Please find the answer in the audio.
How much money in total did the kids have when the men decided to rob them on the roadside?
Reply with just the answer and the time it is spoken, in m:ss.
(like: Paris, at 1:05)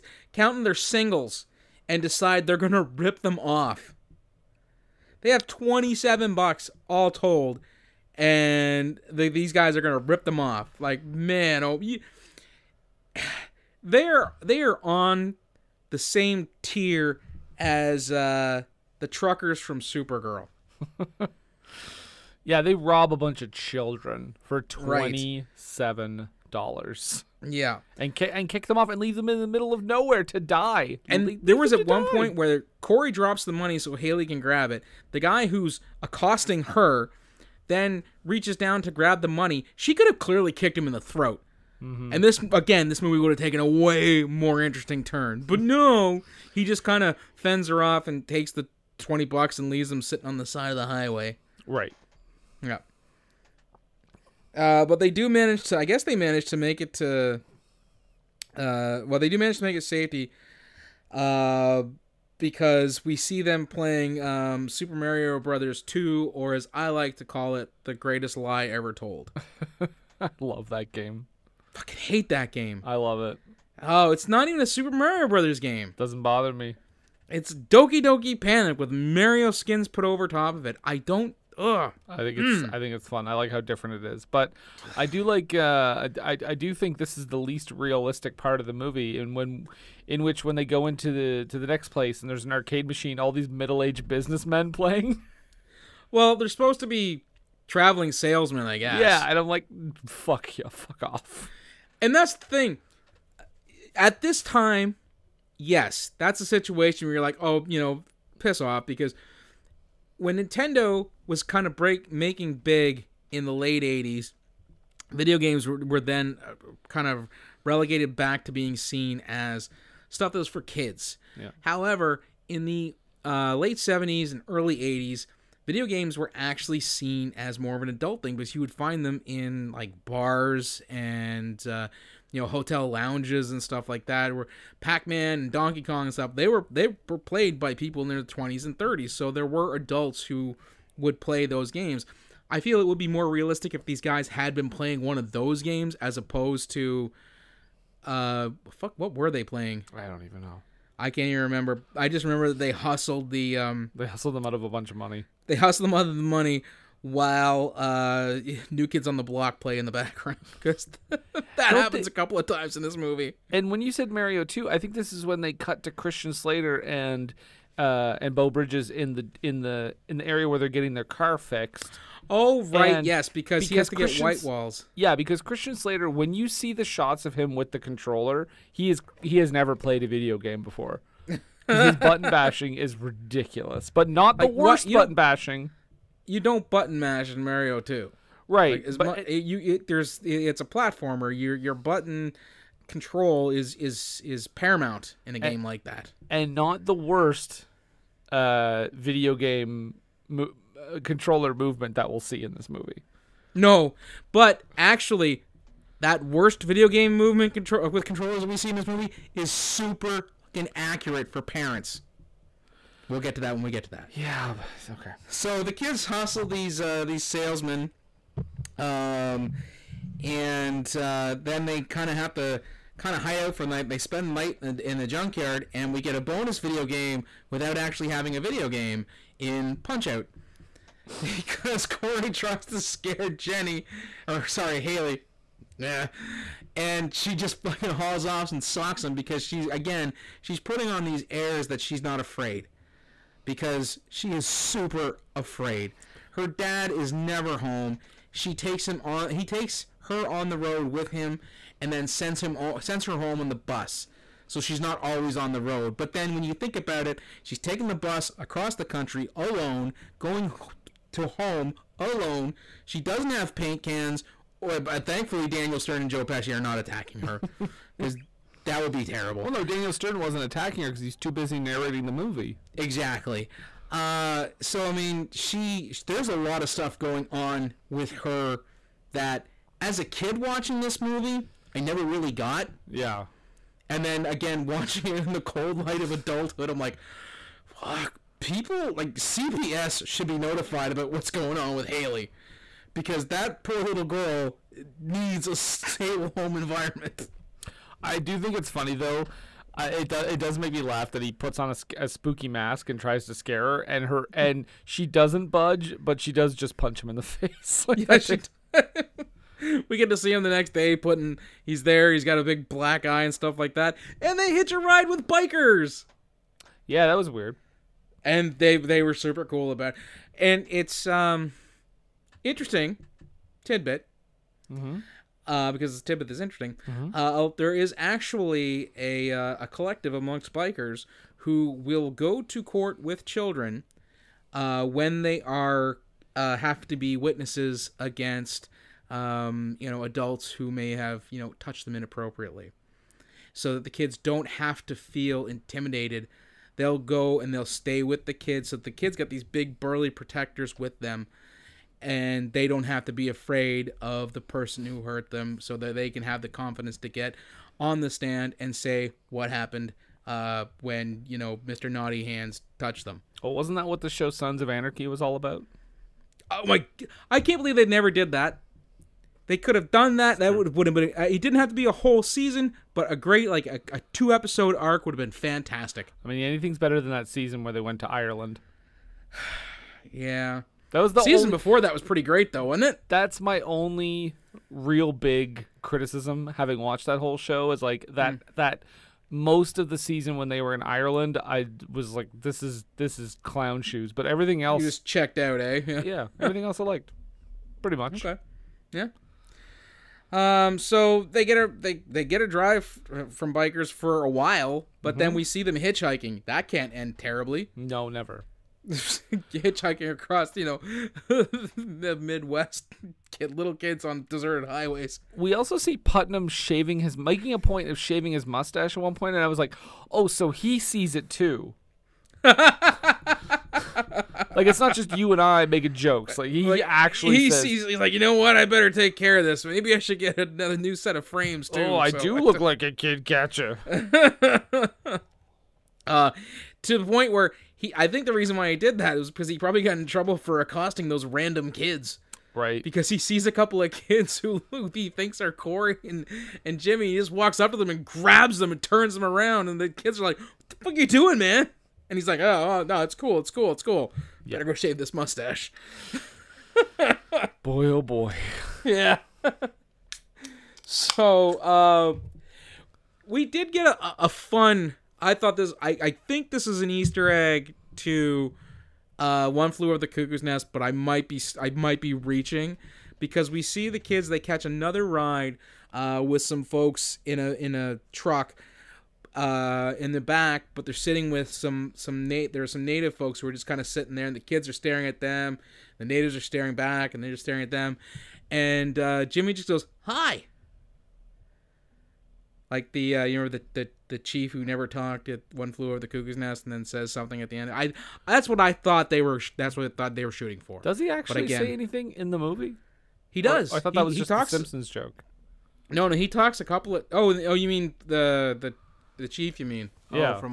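$27, at 0:05.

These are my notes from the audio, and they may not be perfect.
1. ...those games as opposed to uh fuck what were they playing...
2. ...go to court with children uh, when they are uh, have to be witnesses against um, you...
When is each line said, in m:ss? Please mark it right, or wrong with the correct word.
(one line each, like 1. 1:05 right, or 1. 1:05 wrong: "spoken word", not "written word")
1. 2:25 right
2. 5:32 right.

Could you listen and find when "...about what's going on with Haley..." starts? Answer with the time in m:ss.
4:50.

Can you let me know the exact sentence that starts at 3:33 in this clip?
We'll get to that when we get to that.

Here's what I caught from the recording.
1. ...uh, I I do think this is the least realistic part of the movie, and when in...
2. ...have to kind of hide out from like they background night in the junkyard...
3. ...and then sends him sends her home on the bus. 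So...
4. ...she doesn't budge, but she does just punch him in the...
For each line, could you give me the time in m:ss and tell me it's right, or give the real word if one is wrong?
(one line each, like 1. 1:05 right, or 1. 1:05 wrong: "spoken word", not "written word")
1. 1:25 right
2. 3:42 wrong: "spend", not "background"
3. 4:11 right
4. 5:04 right.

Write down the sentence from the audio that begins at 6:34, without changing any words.
But everything else, you just checked out, eh?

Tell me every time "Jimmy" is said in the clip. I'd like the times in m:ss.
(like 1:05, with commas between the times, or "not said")
7:26, 8:09.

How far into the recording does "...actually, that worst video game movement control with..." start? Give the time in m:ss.
3:24.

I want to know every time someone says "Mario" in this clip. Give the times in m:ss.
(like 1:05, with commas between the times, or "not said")
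1:04, 1:14, 1:18, 2:44, 3:07.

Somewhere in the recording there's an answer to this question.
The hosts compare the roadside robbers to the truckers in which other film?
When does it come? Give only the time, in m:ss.
0:19.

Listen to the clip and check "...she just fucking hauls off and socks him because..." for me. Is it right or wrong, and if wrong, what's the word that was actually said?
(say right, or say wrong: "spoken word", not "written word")
right.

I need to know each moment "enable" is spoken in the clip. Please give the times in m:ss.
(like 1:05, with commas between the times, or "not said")
not said.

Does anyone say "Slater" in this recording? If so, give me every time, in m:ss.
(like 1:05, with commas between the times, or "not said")
2:46, 2:55.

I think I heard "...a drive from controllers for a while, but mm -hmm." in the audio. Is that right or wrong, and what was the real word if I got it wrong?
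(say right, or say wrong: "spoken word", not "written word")
wrong: "bikers", not "controllers".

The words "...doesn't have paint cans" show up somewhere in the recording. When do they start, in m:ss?
4:23.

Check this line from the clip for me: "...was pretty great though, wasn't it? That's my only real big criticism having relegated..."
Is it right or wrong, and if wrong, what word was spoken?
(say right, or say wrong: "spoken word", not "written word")
wrong: "watched", not "relegated".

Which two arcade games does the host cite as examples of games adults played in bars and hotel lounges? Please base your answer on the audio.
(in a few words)
Pac-Man and Donkey Kong.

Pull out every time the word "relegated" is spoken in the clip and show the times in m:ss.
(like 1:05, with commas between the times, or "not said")
1:57.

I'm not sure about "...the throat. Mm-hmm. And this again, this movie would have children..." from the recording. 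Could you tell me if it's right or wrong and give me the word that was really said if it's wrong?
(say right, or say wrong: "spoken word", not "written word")
wrong: "taken", not "children".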